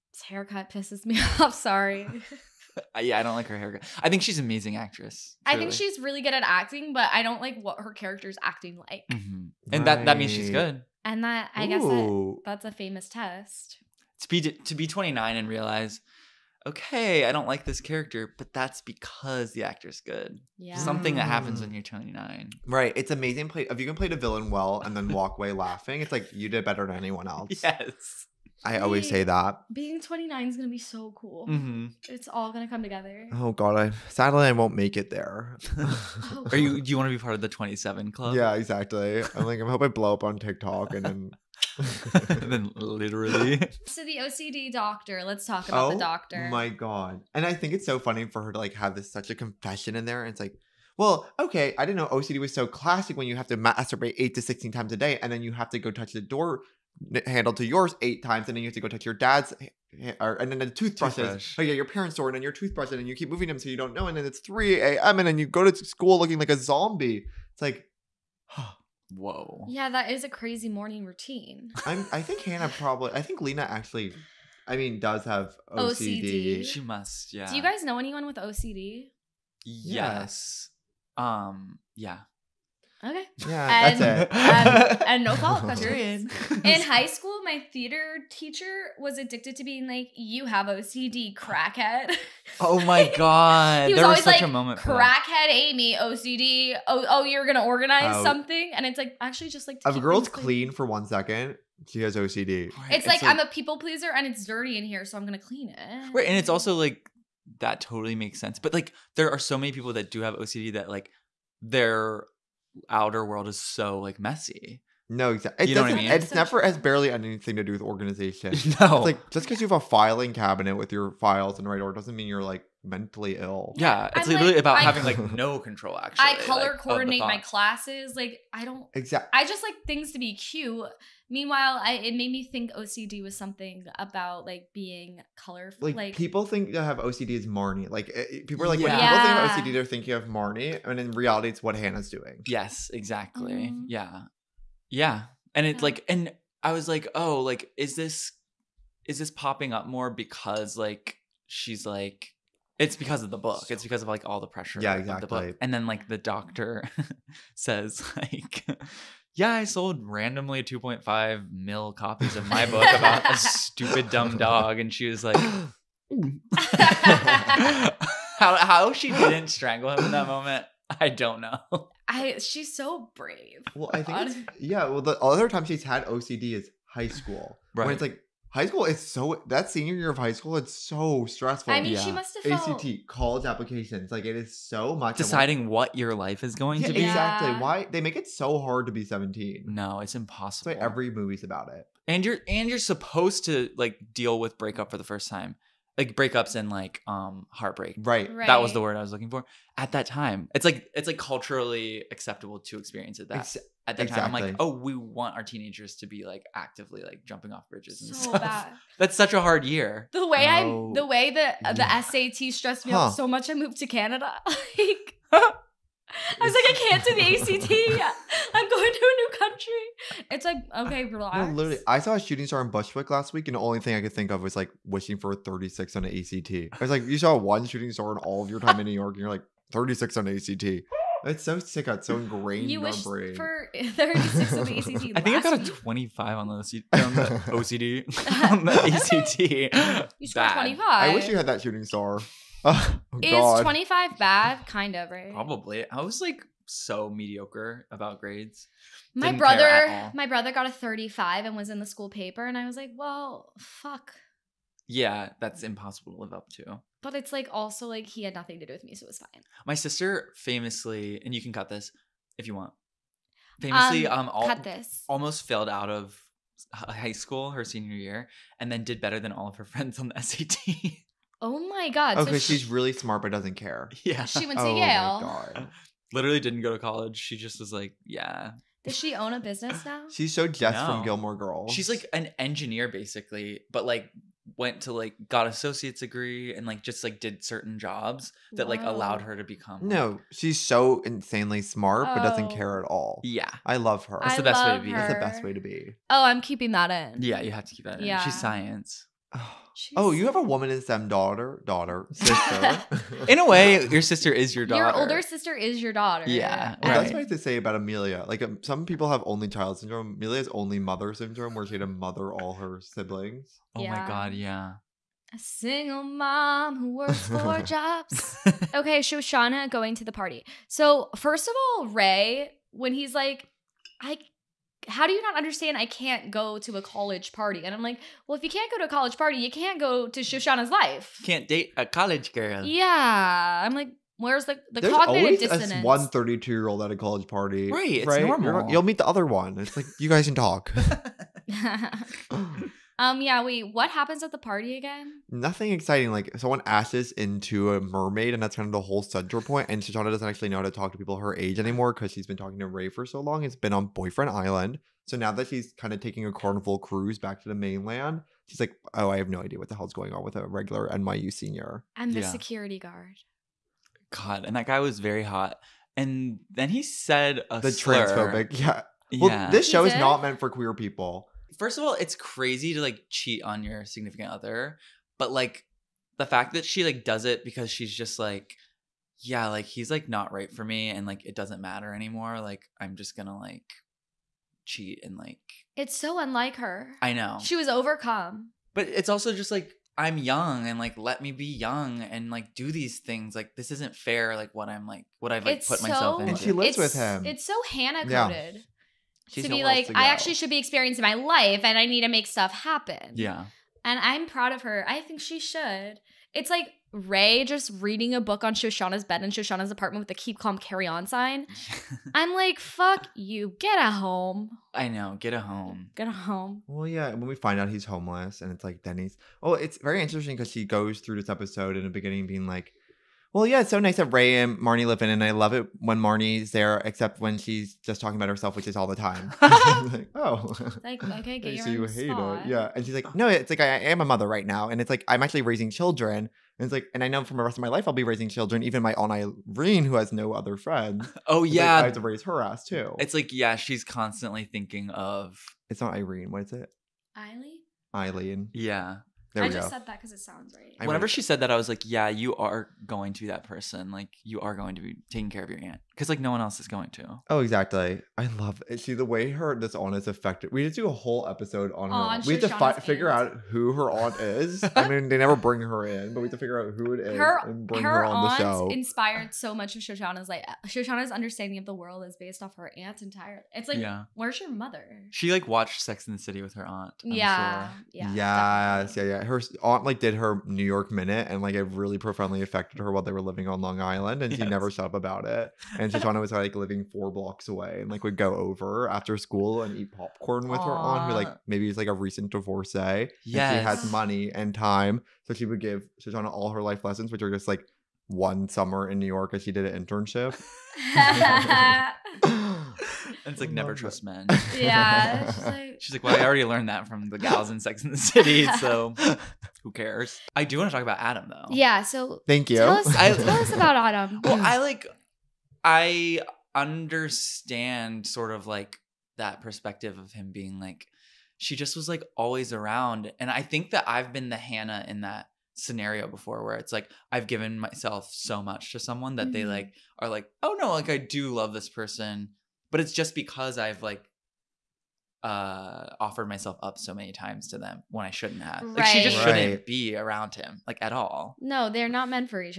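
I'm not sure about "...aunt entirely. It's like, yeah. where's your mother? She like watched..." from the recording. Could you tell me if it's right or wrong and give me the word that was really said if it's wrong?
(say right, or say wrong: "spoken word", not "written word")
right.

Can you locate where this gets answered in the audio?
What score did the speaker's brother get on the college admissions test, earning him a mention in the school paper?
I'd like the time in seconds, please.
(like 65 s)
250 s.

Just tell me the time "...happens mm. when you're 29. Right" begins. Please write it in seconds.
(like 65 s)
21 s.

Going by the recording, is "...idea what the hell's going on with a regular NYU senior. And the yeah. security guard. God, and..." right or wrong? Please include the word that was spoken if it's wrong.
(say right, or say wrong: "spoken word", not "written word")
right.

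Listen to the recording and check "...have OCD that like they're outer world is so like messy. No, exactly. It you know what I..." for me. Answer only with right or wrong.
right.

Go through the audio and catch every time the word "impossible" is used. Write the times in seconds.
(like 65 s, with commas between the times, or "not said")
190 s, 255 s.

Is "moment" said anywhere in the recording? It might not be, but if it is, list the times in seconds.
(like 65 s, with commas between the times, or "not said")
94 s, 170 s.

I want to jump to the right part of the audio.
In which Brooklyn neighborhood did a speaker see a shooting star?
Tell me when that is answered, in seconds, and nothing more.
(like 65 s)
222 s.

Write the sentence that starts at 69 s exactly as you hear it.
Yeah, that is a crazy morning routine.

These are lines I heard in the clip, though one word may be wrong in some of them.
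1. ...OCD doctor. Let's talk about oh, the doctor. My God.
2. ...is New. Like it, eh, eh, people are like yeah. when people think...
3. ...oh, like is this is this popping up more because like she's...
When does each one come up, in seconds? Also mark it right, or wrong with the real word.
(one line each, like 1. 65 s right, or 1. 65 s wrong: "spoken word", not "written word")
1. 44 s right
2. 137 s wrong: "Marnie", not "New"
3. 147 s right.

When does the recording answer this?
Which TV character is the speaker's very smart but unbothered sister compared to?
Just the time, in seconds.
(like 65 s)
280 s.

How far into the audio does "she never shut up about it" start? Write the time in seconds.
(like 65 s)
484 s.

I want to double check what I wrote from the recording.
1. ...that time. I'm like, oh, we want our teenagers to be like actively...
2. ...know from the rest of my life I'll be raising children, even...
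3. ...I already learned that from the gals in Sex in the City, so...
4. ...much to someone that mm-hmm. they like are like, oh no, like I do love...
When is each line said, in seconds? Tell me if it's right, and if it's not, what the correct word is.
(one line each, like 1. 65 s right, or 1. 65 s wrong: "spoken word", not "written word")
1. 203 s right
2. 437 s right
3. 506 s right
4. 528 s right.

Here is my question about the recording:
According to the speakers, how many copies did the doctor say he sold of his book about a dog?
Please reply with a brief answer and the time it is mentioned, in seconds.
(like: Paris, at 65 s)
2.5 million, at 160 s.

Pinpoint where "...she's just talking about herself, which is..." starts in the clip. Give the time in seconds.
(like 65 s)
427 s.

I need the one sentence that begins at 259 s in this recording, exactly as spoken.
My sister famously, and you can cut this if you want.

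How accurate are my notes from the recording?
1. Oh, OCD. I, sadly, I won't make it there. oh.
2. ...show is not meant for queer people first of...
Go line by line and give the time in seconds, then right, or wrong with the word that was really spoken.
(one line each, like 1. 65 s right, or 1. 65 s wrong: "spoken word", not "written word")
1. 33 s wrong: "God", not "OCD"
2. 369 s right.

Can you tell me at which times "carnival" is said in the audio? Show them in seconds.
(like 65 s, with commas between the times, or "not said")
356 s.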